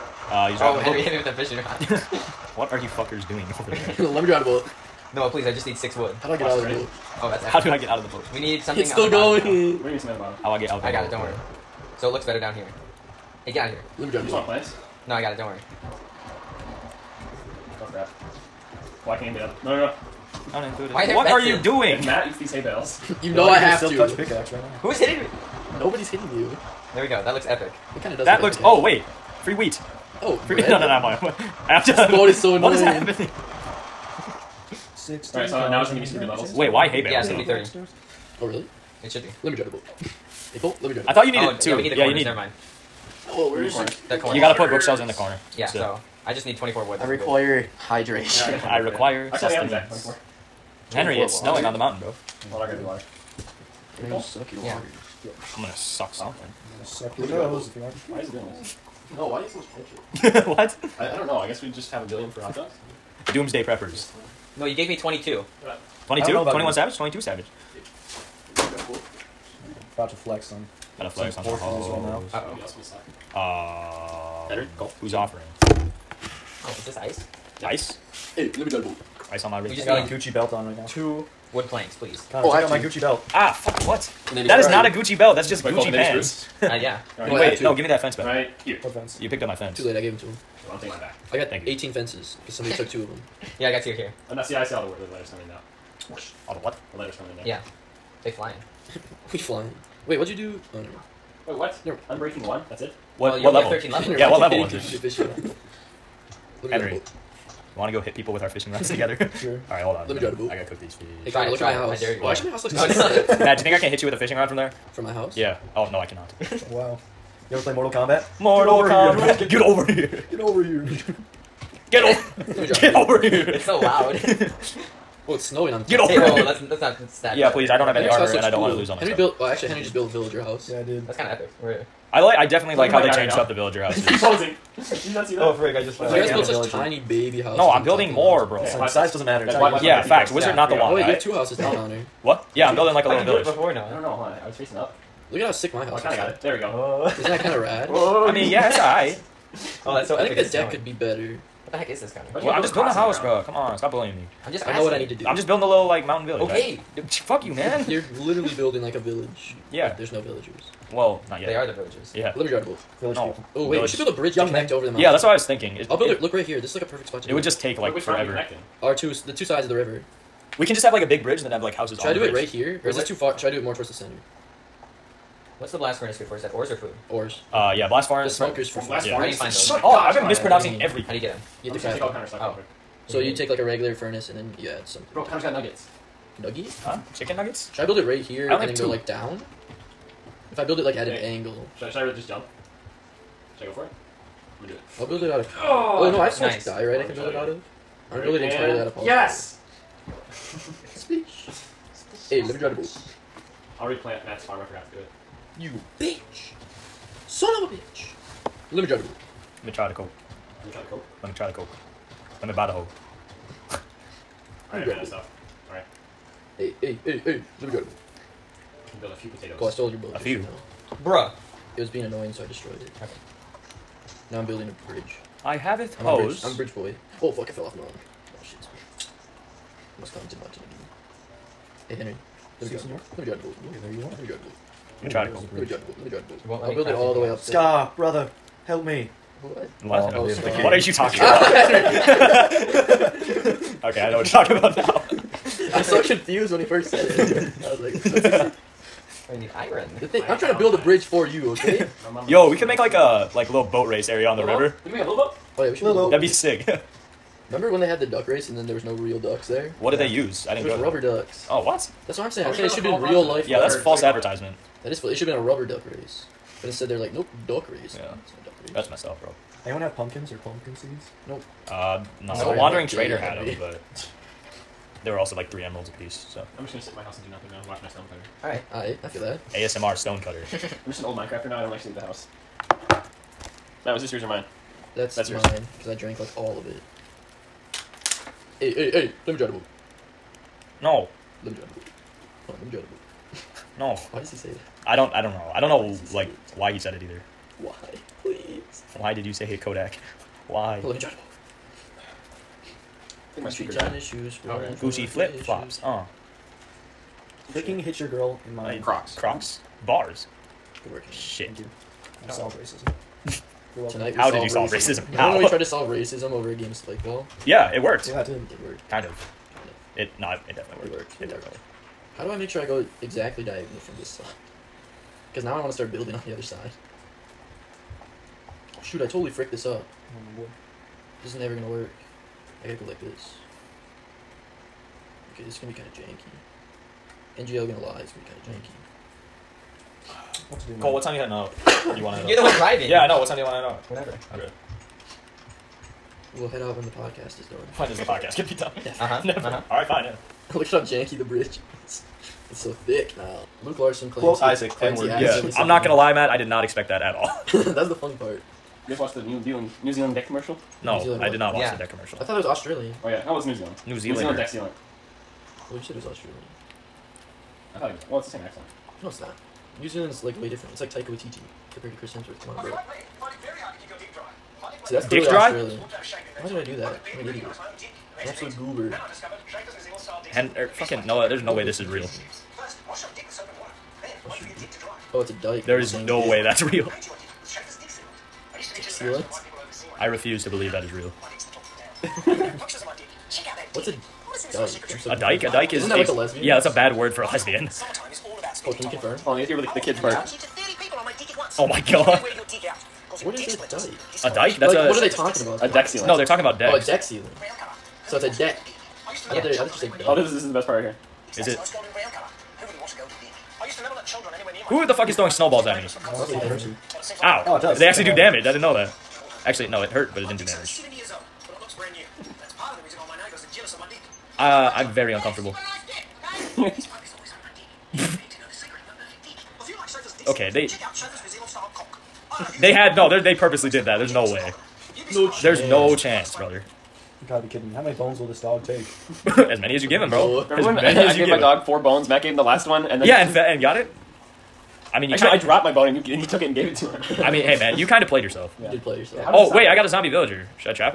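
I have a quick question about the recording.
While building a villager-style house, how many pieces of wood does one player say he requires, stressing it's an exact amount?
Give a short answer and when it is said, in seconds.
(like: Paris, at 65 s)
24, at 49 s.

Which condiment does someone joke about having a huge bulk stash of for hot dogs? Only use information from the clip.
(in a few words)
Ketchup.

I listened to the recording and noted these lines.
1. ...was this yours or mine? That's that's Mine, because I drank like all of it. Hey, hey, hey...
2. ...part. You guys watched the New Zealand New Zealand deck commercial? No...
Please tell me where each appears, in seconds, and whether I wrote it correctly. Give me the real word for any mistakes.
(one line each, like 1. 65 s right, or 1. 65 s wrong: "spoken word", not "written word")
1. 283 s right
2. 358 s right.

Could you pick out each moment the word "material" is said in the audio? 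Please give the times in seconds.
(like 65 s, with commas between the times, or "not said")
not said.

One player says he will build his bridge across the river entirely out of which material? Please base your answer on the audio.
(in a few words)
Polyester.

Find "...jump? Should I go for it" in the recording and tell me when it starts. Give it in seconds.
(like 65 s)
192 s.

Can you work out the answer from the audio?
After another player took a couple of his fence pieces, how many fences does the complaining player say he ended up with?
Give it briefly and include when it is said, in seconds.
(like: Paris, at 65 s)
18, at 91 s.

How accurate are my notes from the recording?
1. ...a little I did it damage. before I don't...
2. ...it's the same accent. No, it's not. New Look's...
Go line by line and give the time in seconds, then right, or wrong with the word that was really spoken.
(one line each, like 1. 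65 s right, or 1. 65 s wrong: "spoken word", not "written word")
1. 143 s wrong: "village", not "damage"
2. 368 s wrong: "Zealand", not "Look".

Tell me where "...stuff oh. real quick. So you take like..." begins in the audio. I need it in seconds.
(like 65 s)
182 s.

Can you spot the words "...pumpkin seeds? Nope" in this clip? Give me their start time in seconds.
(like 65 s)
270 s.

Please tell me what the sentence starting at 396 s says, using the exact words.
Yeah, that's a bad word for a lesbian.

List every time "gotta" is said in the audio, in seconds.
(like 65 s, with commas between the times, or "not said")
44 s, 52 s, 110 s, 332 s, 437 s.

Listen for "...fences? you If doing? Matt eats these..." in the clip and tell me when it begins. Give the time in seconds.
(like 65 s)
21 s.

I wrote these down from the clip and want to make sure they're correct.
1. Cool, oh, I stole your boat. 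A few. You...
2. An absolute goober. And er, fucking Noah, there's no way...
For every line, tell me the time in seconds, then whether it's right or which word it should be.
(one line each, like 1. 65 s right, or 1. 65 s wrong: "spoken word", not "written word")
1. 219 s right
2. 378 s right.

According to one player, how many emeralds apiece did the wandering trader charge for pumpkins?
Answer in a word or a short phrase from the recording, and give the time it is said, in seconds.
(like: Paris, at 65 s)
3, at 275 s.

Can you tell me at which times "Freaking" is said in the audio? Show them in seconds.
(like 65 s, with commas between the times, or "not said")
307 s.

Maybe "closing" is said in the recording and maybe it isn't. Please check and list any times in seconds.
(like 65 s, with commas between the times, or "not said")
134 s.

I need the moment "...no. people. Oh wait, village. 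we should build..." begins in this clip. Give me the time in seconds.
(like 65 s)
163 s.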